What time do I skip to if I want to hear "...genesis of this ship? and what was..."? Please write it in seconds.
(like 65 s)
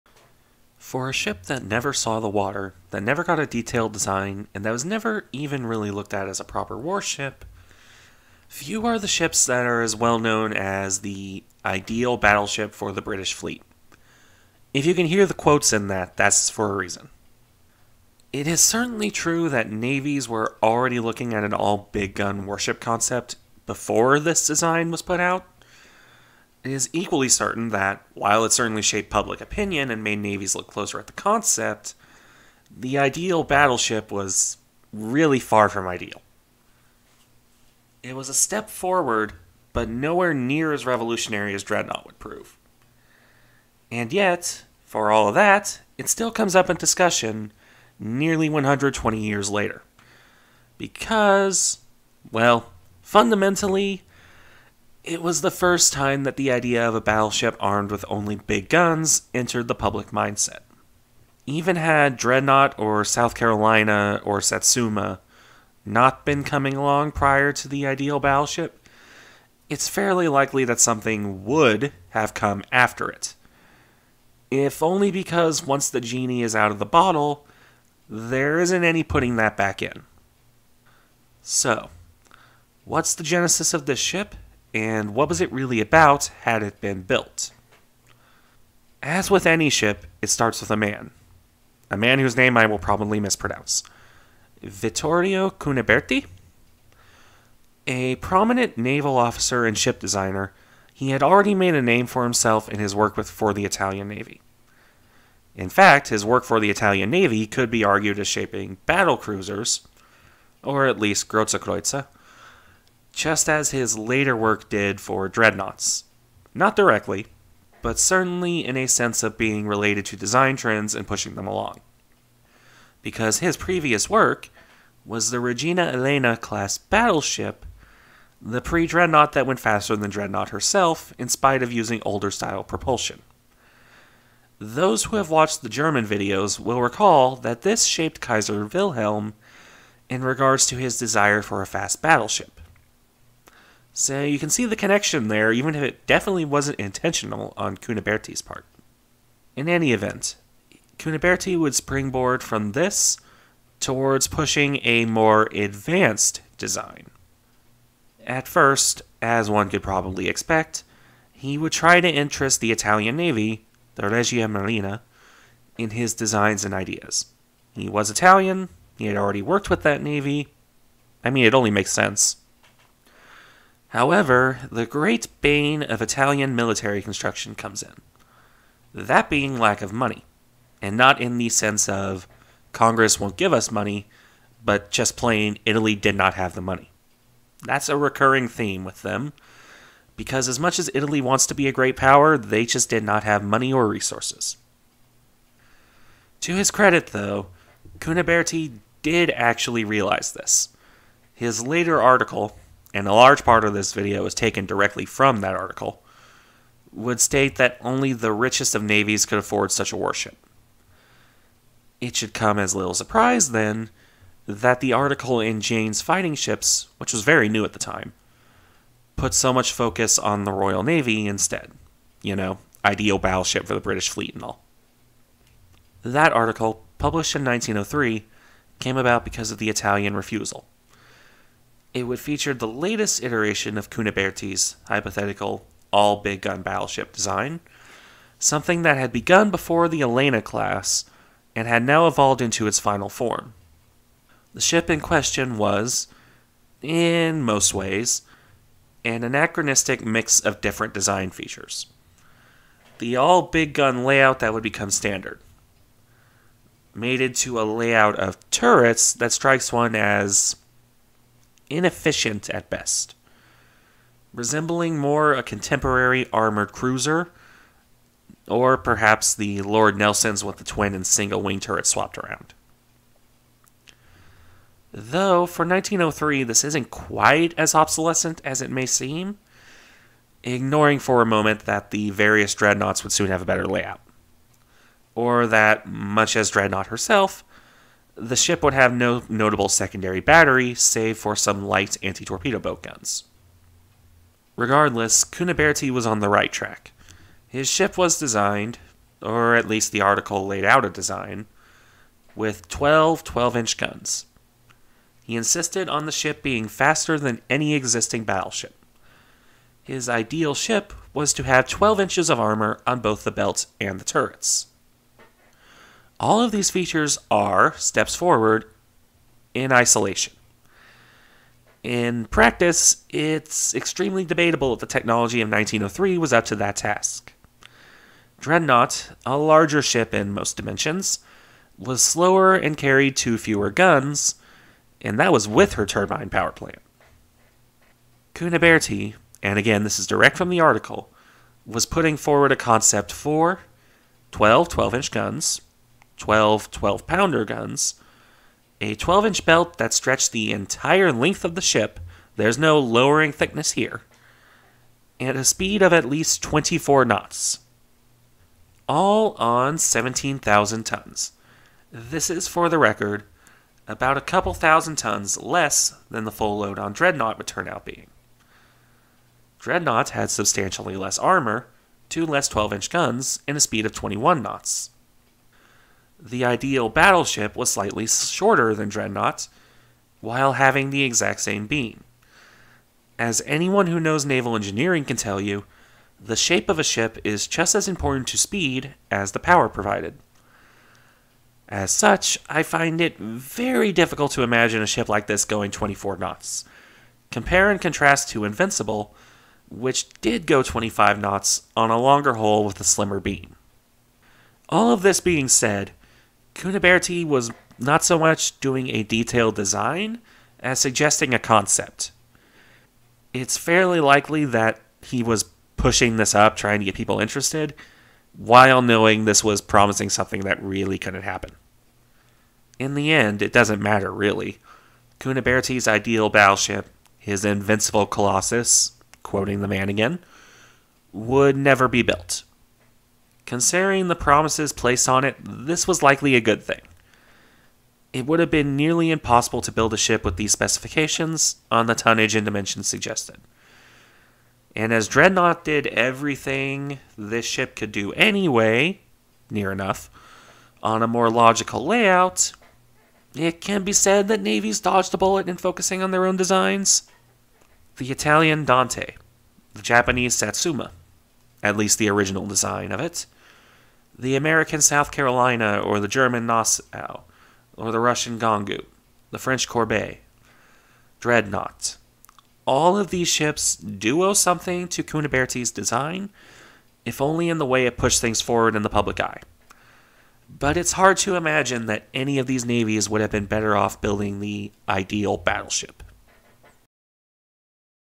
83 s.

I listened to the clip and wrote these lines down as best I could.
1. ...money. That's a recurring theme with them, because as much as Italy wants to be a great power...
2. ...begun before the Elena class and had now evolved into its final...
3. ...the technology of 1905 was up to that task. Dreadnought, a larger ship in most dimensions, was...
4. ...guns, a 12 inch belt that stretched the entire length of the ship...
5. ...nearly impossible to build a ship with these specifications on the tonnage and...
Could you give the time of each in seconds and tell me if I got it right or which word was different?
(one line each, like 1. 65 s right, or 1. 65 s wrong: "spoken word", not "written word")
1. 186 s right
2. 239 s right
3. 324 s wrong: "1903", not "1905"
4. 347 s right
5. 438 s right.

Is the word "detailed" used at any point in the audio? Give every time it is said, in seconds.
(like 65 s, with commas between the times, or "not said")
3 s, 409 s.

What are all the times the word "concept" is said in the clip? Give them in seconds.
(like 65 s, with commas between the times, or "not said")
22 s, 31 s, 342 s, 411 s.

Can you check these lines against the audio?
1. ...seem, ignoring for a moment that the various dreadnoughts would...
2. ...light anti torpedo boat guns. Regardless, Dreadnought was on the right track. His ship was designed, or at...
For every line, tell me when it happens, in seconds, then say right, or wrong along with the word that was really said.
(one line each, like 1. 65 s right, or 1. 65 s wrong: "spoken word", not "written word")
1. 278 s right
2. 291 s wrong: "Cuniberti", not "Dreadnought".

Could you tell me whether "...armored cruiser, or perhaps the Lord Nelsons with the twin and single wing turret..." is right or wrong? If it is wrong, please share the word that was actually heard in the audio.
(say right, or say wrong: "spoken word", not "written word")
right.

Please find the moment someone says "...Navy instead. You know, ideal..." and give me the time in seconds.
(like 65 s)
220 s.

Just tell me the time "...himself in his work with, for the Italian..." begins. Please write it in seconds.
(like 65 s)
102 s.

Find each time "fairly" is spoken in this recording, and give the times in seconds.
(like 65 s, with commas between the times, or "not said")
69 s, 413 s.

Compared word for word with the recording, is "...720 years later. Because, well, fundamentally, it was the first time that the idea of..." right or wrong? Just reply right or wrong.
wrong.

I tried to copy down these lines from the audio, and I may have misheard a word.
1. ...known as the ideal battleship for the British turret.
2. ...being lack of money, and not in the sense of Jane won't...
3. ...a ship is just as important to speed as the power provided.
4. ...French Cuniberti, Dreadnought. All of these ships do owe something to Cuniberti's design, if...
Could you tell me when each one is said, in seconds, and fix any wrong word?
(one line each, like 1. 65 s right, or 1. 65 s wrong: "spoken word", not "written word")
1. 10 s wrong: "fleet", not "turret"
2. 179 s wrong: "Congress", not "Jane"
3. 386 s right
4. 469 s wrong: "Courbet", not "Cuniberti".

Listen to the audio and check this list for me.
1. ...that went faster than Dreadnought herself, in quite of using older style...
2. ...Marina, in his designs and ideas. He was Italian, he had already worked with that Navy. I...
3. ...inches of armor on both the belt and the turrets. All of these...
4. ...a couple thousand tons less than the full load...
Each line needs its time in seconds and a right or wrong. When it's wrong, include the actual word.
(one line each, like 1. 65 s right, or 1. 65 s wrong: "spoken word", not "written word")
1. 129 s wrong: "spite", not "quite"
2. 164 s right
3. 311 s right
4. 364 s right.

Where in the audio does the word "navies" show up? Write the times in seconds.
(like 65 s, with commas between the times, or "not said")
19 s, 30 s, 208 s, 454 s, 482 s.